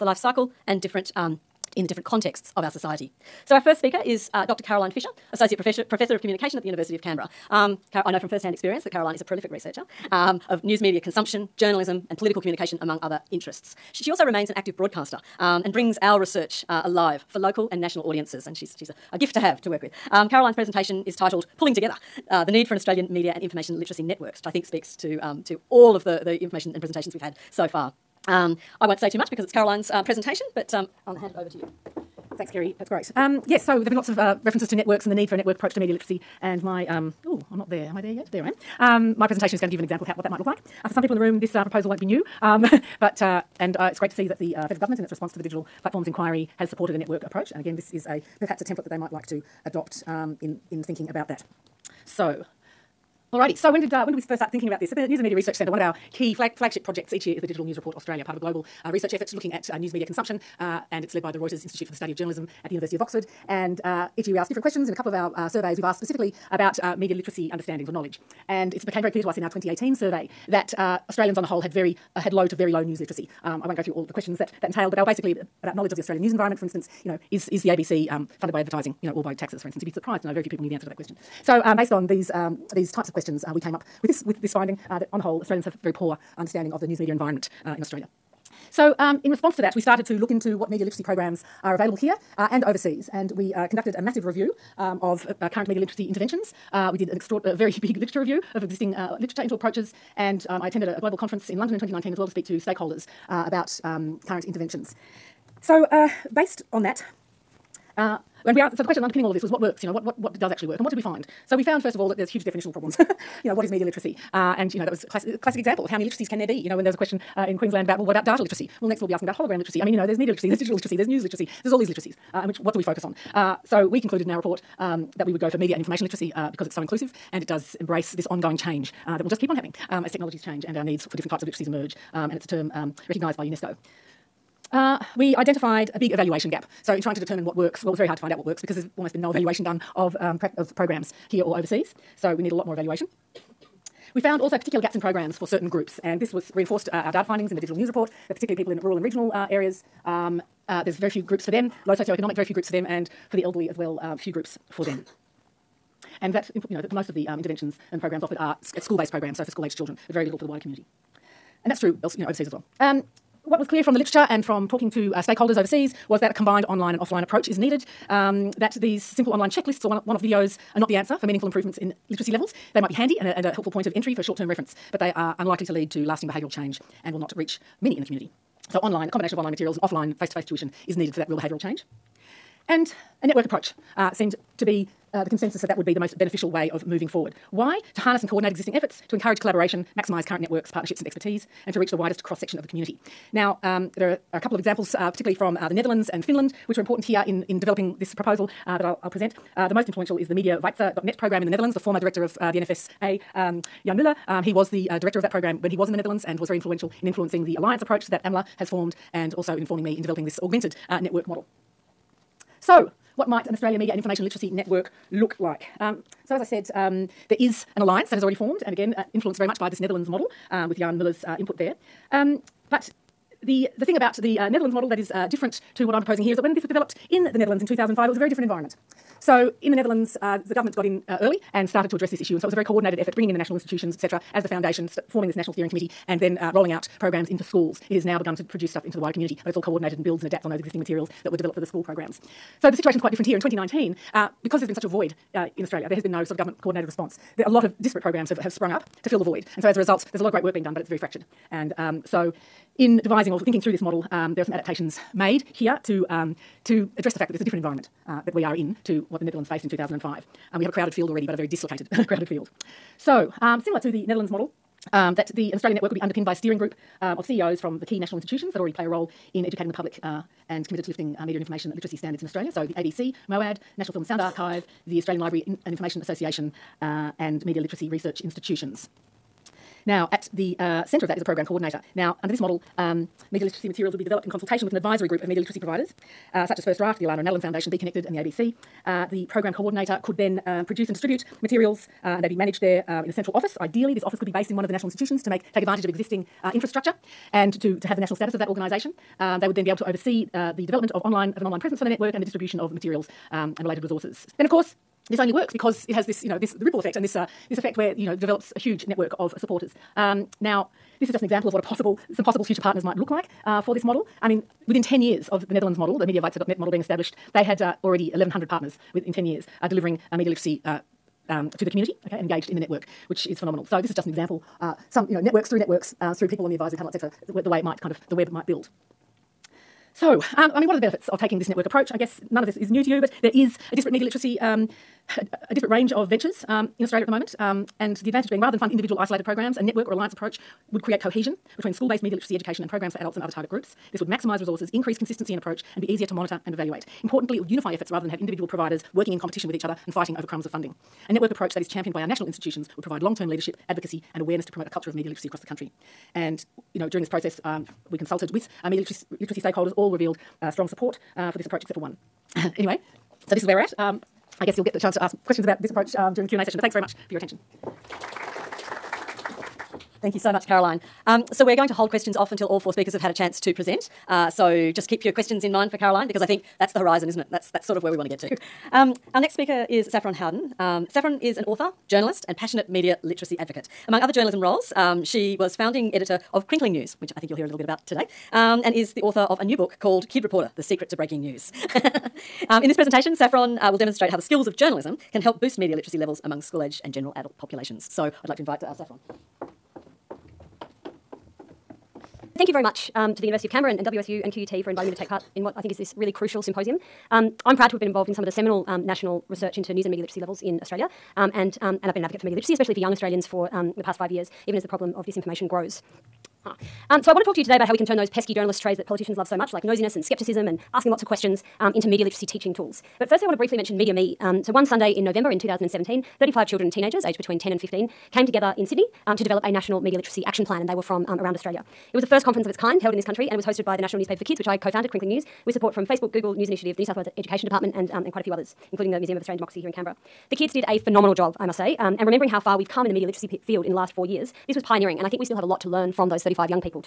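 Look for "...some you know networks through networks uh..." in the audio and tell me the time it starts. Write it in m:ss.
5:24.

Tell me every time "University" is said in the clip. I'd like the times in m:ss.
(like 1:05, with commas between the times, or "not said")
0:06, 1:02, 6:43.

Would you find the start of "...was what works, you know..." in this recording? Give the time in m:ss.
1:49.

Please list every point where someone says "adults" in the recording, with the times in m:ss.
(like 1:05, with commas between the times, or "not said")
5:42, 6:37.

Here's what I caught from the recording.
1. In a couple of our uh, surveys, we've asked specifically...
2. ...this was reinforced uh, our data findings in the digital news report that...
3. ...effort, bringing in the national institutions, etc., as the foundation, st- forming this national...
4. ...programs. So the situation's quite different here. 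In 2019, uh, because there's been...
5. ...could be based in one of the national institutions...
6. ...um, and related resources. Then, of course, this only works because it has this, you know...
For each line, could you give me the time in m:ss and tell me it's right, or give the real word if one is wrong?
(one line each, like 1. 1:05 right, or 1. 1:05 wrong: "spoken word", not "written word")
1. 1:04 right
2. 2:26 right
3. 3:52 right
4. 4:01 right
5. 4:54 right
6. 5:03 right.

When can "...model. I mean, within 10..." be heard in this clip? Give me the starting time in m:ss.
5:13.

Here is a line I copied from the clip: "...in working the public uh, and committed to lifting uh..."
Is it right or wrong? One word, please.
wrong.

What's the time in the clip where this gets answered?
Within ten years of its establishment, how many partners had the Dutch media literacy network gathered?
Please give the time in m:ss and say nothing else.
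5:18.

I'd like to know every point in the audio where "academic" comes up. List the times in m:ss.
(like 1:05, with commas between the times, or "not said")
not said.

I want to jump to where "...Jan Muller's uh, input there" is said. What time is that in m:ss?
3:40.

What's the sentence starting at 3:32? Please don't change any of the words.
So, what might an Australia Media and Information Literacy Network look like.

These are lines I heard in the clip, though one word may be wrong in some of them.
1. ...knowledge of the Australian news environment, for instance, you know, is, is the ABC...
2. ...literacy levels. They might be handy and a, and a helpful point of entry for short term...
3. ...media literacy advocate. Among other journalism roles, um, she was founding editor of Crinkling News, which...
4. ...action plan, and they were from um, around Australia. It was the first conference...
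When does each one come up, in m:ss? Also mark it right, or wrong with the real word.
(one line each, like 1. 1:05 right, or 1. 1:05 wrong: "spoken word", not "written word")
1. 1:15 right
2. 2:52 right
3. 6:22 right
4. 7:10 right.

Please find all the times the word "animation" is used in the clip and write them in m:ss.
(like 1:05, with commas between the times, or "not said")
not said.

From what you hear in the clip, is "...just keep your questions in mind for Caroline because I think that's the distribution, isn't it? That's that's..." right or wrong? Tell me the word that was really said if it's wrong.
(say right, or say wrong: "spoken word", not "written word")
wrong: "horizon", not "distribution".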